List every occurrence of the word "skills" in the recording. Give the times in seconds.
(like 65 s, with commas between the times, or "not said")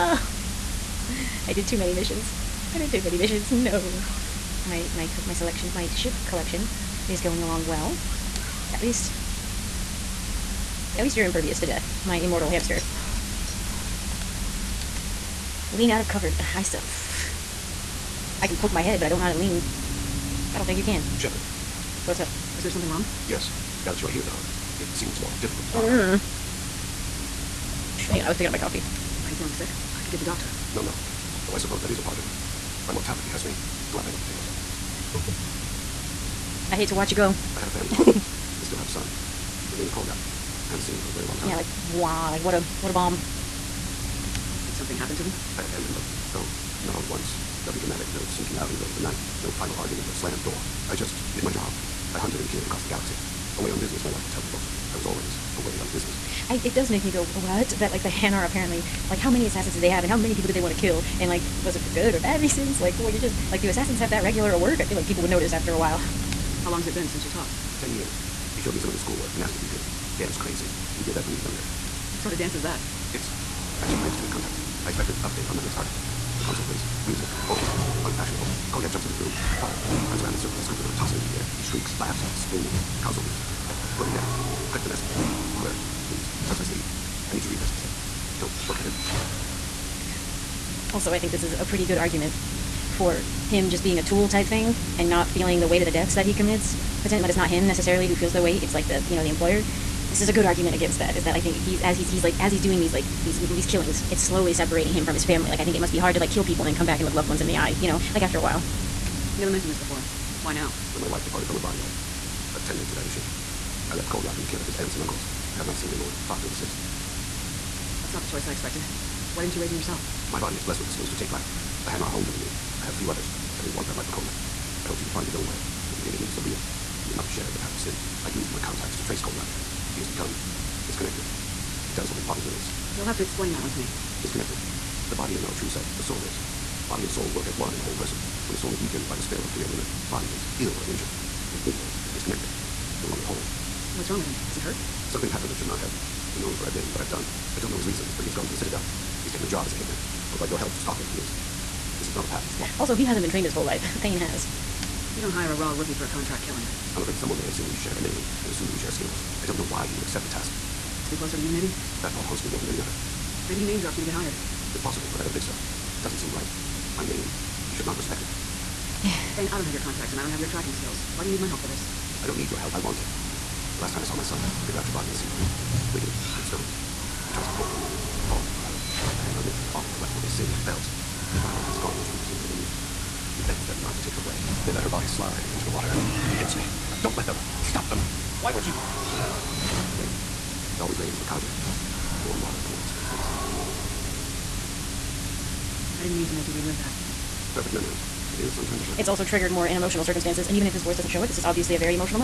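120 s, 158 s, 170 s.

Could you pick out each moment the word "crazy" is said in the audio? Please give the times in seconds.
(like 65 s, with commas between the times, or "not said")
70 s.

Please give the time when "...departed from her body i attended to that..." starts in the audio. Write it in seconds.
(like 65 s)
111 s.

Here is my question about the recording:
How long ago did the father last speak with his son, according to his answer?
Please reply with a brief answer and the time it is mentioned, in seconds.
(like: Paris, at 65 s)
10 years, at 67 s.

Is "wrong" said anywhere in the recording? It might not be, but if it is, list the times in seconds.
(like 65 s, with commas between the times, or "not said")
22 s, 144 s.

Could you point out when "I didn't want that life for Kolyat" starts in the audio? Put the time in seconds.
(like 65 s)
123 s.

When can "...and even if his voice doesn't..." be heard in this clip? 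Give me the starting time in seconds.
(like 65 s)
200 s.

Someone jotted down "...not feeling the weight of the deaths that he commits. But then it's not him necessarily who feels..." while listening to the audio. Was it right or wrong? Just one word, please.
right.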